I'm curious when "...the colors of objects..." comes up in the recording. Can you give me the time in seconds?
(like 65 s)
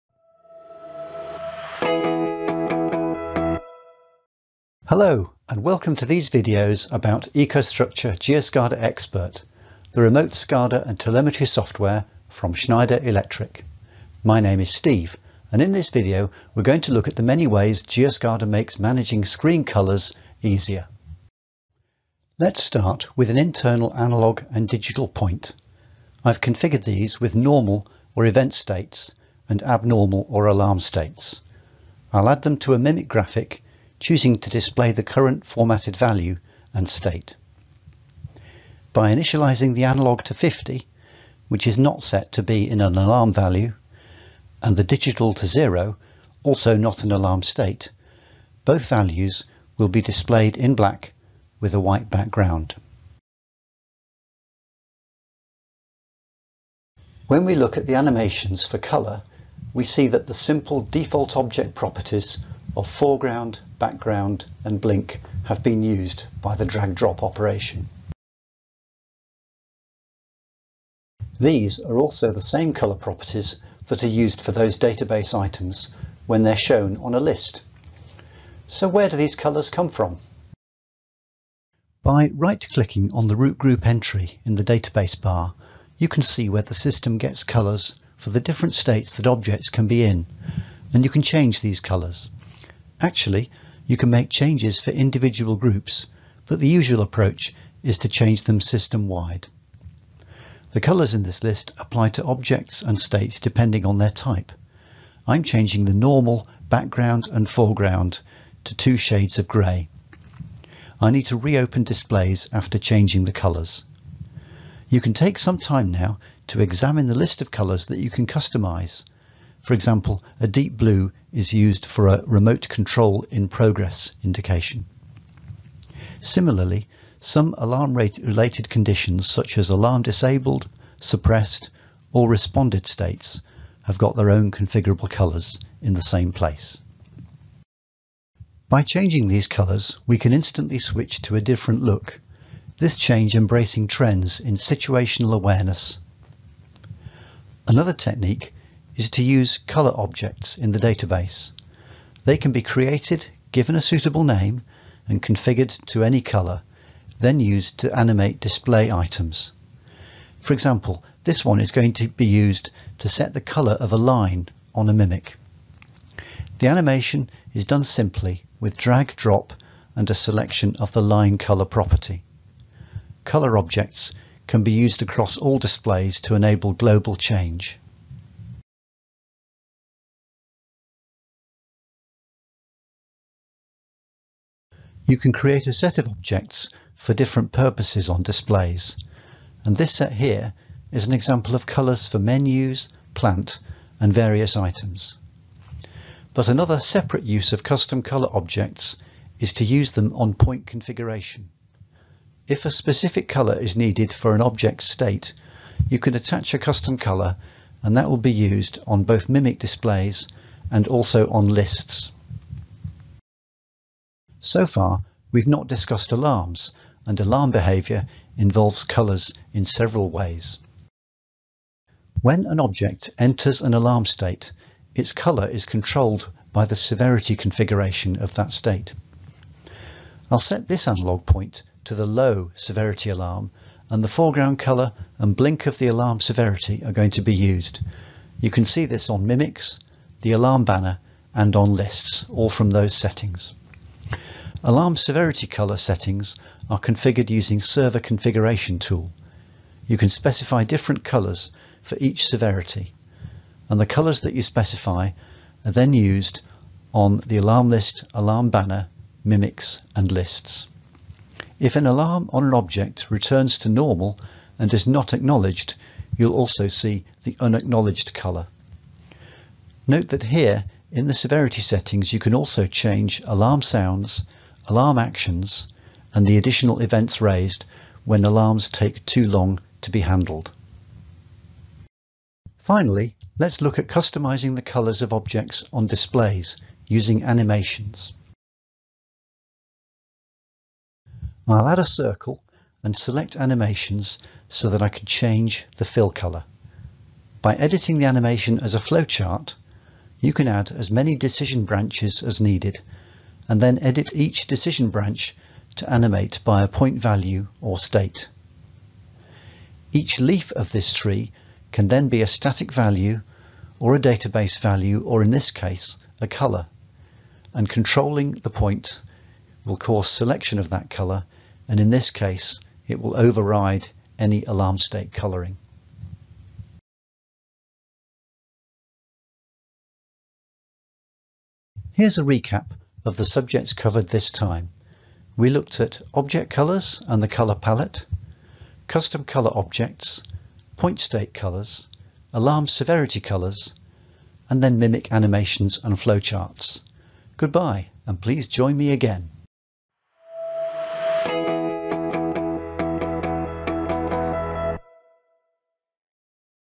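284 s.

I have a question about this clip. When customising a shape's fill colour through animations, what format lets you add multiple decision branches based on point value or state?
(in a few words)
Flowchart.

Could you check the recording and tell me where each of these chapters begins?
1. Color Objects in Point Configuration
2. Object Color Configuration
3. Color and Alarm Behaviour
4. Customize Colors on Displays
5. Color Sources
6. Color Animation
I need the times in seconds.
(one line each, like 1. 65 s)
1. 195 s
2. 21 s
3. 213 s
4. 282 s
5. 78 s
6. 137 s.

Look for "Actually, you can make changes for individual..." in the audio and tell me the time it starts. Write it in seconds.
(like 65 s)
92 s.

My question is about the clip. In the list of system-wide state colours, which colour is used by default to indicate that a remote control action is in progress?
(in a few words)
Deep blue.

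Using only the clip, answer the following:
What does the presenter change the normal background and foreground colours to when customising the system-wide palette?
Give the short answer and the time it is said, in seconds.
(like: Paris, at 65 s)
Two shades of grey, at 108 s.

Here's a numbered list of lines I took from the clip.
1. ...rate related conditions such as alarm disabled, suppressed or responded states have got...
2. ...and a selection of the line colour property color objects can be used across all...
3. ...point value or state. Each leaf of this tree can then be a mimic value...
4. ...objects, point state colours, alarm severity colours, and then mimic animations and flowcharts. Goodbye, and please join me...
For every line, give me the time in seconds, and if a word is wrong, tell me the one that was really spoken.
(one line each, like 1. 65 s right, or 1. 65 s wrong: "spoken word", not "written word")
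1. 127 s right
2. 169 s right
3. 306 s wrong: "static", not "mimic"
4. 339 s right.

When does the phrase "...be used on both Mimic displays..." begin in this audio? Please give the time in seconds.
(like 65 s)
208 s.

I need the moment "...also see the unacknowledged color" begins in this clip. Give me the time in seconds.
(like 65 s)
266 s.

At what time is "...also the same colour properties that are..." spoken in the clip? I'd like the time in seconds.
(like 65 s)
71 s.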